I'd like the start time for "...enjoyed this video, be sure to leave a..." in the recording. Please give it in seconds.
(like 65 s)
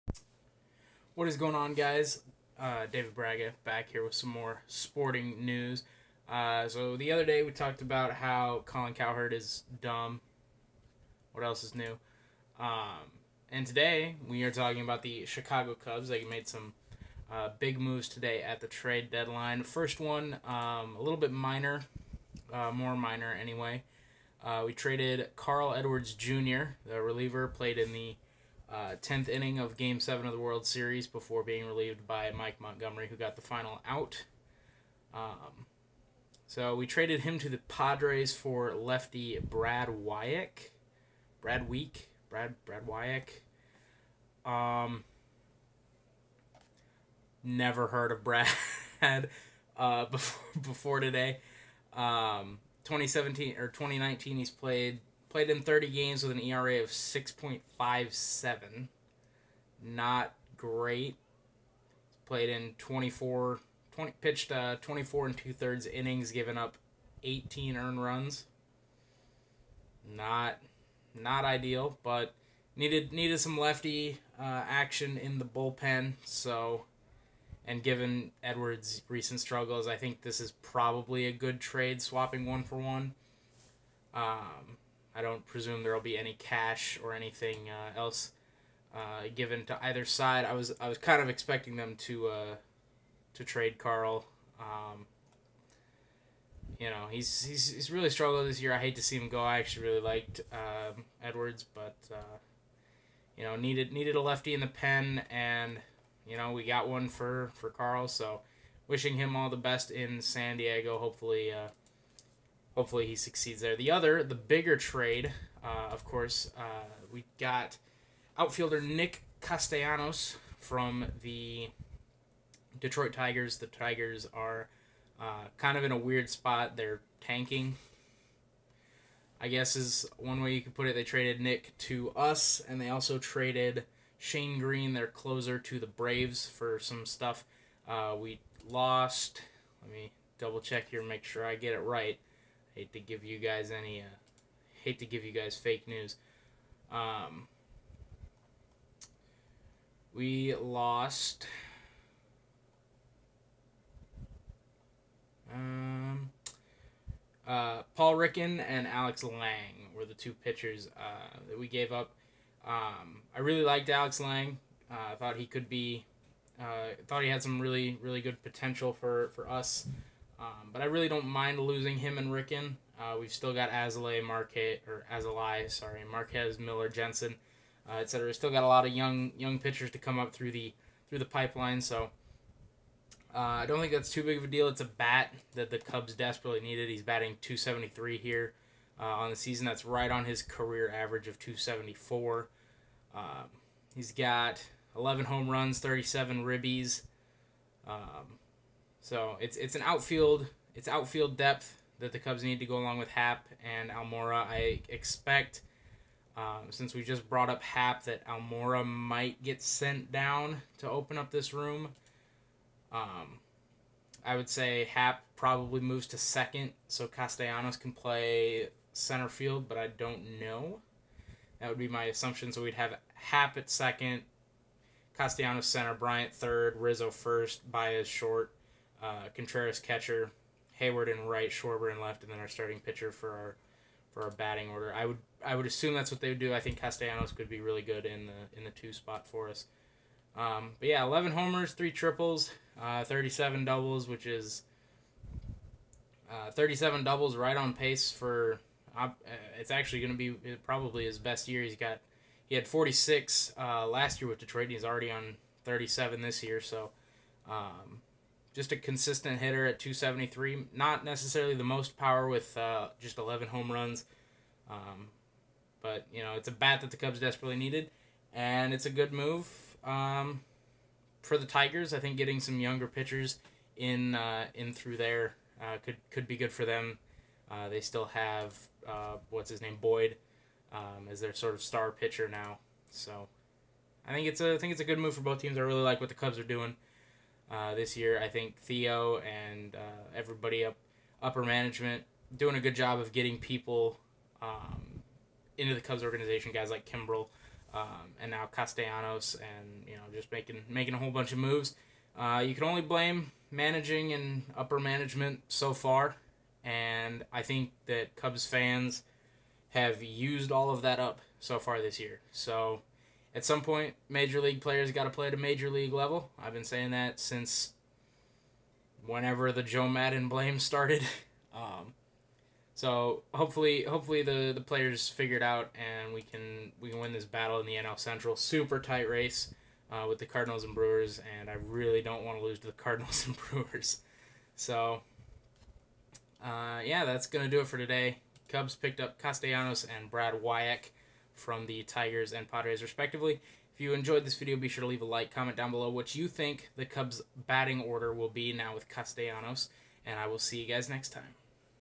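343 s.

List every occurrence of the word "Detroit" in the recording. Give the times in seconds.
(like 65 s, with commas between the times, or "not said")
122 s, 254 s.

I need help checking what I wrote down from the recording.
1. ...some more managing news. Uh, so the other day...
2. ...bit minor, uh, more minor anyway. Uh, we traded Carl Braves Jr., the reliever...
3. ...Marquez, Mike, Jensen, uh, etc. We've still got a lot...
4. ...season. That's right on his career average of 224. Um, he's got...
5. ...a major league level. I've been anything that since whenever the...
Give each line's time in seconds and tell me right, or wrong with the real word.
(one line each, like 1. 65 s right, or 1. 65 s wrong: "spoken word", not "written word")
1. 4 s wrong: "sporting", not "managing"
2. 21 s wrong: "Edwards", not "Braves"
3. 176 s wrong: "Miller", not "Mike"
4. 189 s wrong: "274", not "224"
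5. 315 s wrong: "saying", not "anything".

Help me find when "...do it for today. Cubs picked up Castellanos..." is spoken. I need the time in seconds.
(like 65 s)
337 s.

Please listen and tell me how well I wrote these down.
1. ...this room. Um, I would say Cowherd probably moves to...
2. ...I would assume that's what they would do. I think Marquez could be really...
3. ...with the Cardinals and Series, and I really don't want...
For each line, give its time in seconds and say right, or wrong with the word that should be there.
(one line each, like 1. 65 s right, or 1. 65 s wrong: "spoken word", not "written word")
1. 211 s wrong: "Happ", not "Cowherd"
2. 235 s wrong: "Castellanos", not "Marquez"
3. 330 s wrong: "Brewers", not "Series".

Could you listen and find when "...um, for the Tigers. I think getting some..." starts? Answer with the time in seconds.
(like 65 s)
269 s.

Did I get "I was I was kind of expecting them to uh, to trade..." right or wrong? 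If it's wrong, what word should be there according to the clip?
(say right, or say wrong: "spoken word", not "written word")
right.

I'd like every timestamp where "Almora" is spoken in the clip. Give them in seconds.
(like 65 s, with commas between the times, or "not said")
203 s, 208 s.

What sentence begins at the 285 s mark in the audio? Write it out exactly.
I really like what the Cubs are doing uh, this year.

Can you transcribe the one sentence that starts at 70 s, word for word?
Not, not ideal, but needed needed some lefty uh, action in the bullpen.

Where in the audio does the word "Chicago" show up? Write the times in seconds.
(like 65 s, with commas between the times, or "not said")
15 s.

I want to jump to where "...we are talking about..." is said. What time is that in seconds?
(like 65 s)
14 s.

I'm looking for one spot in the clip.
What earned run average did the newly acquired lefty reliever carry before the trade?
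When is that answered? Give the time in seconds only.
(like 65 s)
56 s.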